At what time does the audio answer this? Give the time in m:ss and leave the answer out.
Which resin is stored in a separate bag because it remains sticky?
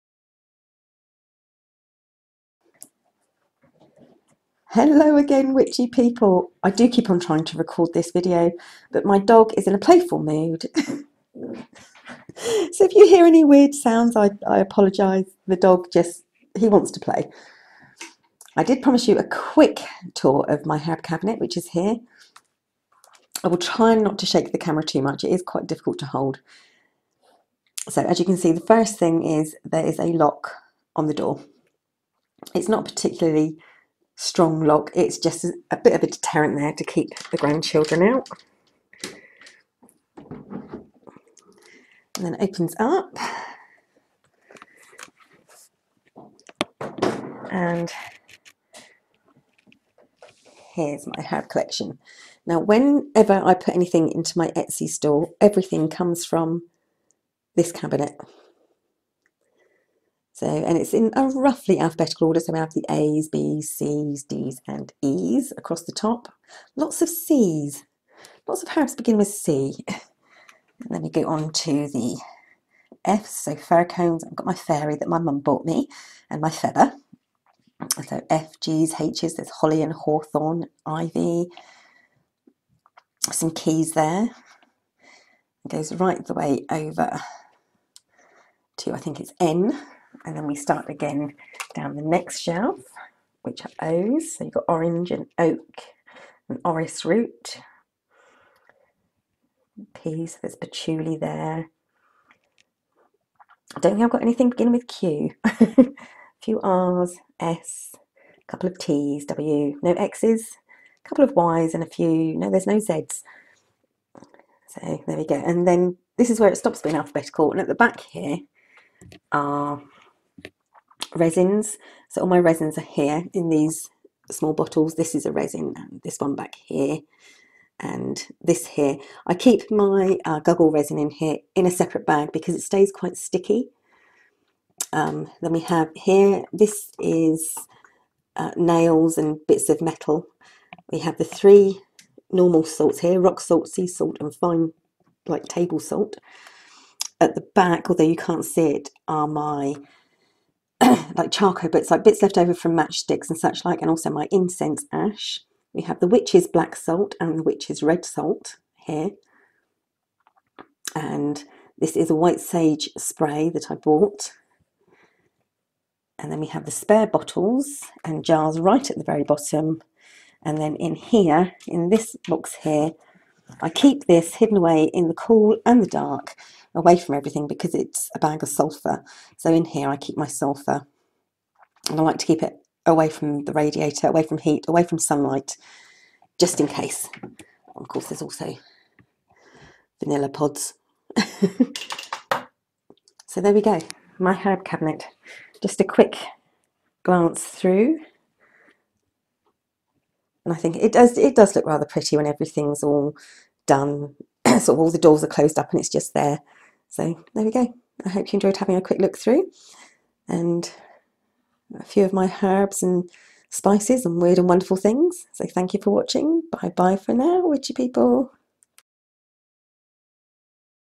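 2:10.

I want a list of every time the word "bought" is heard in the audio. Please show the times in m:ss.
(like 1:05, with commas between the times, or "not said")
1:15, 2:43.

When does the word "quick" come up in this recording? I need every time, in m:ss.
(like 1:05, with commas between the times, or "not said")
0:19, 3:15, 3:28.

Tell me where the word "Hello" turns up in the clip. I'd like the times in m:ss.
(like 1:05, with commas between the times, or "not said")
0:04.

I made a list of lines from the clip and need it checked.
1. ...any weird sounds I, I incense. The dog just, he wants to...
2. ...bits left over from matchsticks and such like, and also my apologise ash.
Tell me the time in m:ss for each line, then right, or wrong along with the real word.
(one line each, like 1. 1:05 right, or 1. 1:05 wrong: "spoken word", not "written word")
1. 0:13 wrong: "apologise", not "incense"
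2. 2:32 wrong: "incense", not "apologise".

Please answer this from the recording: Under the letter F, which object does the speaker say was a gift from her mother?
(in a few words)
Fairy.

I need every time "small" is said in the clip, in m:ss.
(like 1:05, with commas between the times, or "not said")
2:04.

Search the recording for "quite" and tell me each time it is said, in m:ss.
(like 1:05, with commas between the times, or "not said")
0:25, 2:12.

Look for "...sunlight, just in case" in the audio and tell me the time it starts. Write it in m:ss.
3:04.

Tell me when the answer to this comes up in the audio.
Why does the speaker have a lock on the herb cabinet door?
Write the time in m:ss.
0:36.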